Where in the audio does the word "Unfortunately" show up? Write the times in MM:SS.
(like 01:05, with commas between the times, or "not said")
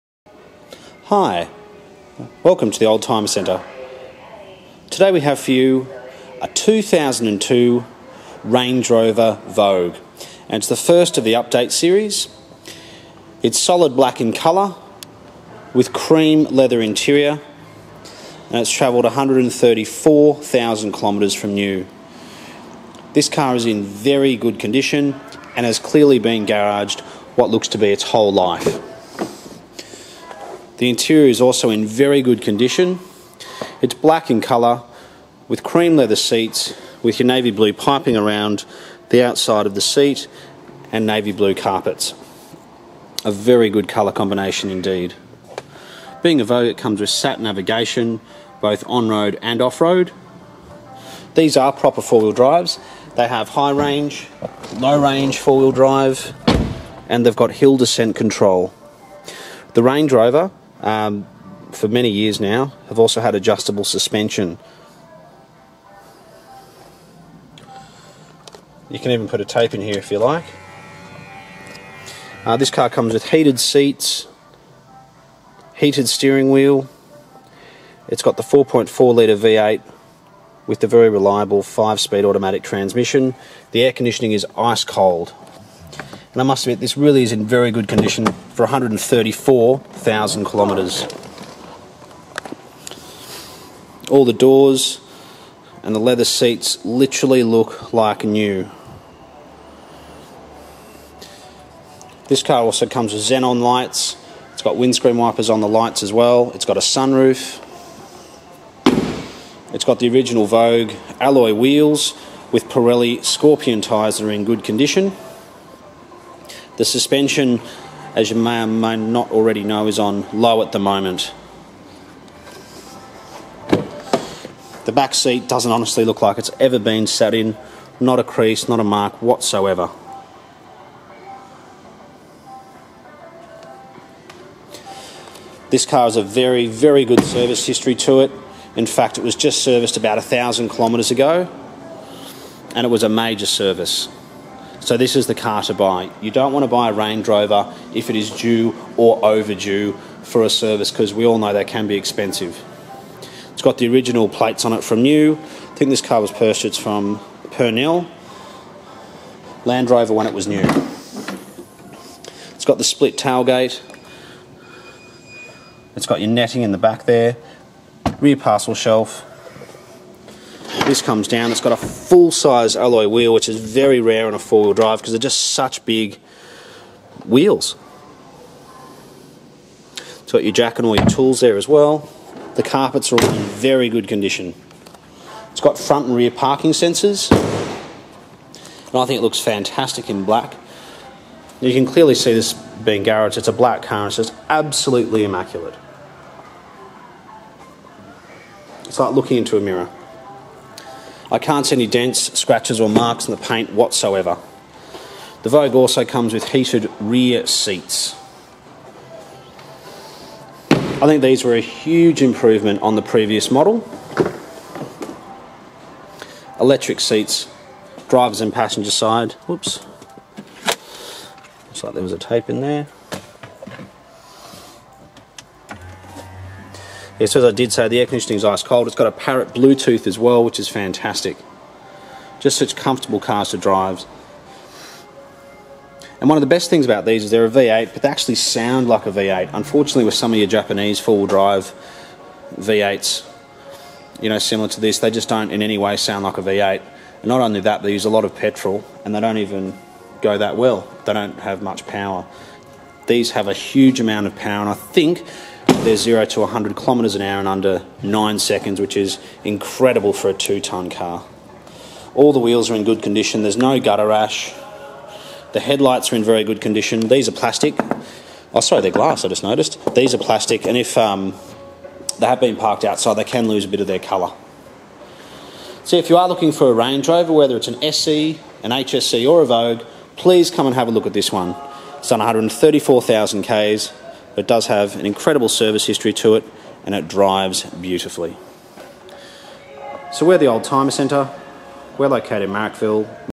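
03:59.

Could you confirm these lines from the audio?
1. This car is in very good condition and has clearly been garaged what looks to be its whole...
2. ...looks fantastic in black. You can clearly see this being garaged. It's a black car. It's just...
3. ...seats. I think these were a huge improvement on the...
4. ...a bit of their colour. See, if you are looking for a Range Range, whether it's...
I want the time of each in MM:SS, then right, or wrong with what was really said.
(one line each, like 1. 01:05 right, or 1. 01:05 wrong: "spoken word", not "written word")
1. 00:23 right
2. 03:09 right
3. 03:27 right
4. 04:33 wrong: "Rover", not "Range".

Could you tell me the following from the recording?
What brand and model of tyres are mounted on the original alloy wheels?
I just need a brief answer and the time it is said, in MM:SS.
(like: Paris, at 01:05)
Pirelli Scorpion, at 01:52.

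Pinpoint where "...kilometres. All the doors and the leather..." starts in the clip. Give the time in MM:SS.
01:30.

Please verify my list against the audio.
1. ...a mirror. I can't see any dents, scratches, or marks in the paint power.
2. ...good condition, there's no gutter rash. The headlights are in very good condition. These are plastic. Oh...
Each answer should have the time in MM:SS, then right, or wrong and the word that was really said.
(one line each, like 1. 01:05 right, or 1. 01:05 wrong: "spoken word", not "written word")
1. 03:19 wrong: "whatsoever", not "power"
2. 04:22 right.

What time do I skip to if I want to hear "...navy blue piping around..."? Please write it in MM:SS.
00:37.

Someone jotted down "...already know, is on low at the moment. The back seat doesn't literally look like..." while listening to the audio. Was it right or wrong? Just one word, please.
wrong.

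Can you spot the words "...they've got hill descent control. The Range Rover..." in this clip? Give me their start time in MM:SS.
00:57.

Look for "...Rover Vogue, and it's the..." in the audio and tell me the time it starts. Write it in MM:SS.
00:08.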